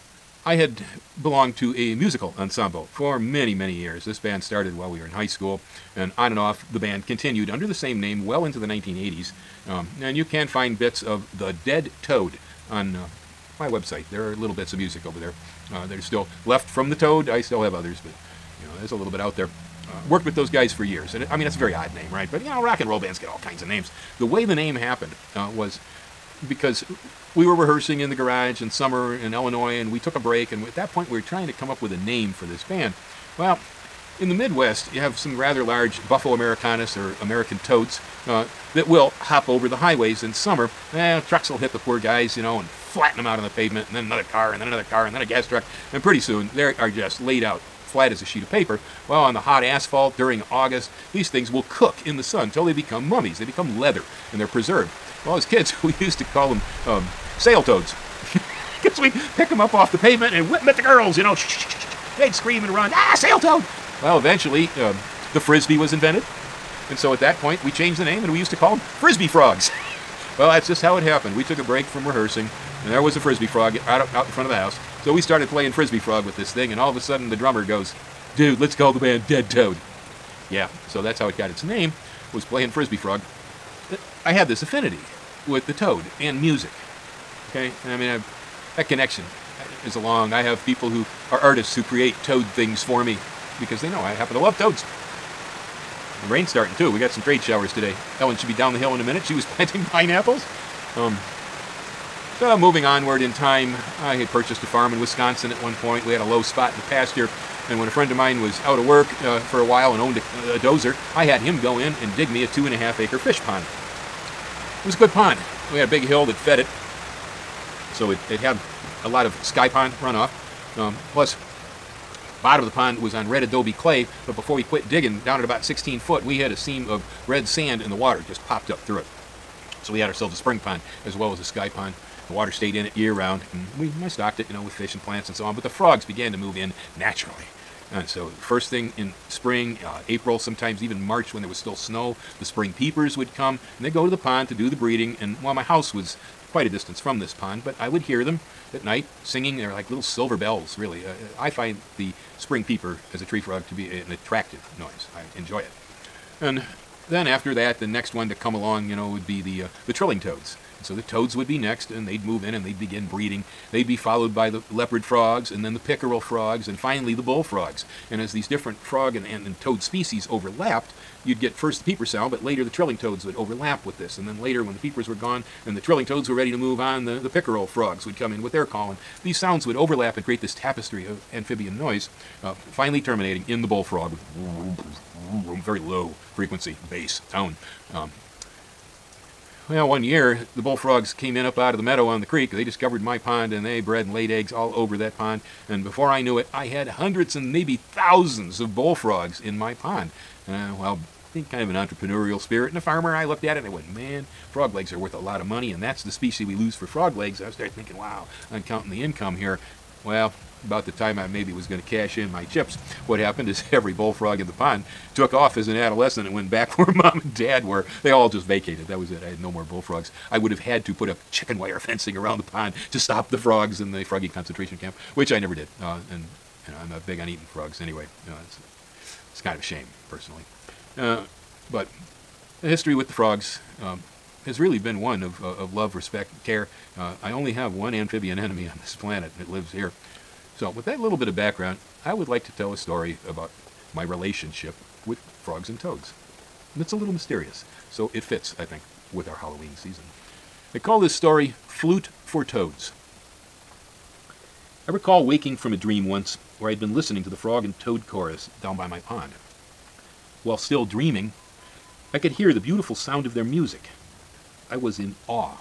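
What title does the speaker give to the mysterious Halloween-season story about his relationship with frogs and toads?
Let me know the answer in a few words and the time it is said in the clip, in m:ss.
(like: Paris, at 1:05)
Flute for Toads, at 4:11.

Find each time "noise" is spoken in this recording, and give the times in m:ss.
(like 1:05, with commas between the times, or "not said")
2:34, 3:01.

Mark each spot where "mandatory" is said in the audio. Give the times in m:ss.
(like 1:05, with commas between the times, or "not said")
not said.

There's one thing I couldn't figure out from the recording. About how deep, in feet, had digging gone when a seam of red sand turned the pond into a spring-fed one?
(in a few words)
16 feet.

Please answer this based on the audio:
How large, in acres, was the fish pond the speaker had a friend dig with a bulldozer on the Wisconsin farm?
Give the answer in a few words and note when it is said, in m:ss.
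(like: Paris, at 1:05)
2.5 acres, at 1:52.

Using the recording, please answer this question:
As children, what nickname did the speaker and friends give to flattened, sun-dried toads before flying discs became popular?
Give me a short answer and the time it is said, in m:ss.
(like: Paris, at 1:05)
sail toads, at 0:57.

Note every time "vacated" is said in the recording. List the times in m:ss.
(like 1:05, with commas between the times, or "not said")
3:38.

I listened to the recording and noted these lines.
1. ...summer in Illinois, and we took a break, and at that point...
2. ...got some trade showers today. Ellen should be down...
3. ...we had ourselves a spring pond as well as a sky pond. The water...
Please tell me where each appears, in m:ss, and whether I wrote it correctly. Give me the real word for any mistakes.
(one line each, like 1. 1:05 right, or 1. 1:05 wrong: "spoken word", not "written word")
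1. 0:28 right
2. 1:36 right
3. 2:09 right.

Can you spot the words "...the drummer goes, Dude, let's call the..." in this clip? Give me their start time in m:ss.
1:17.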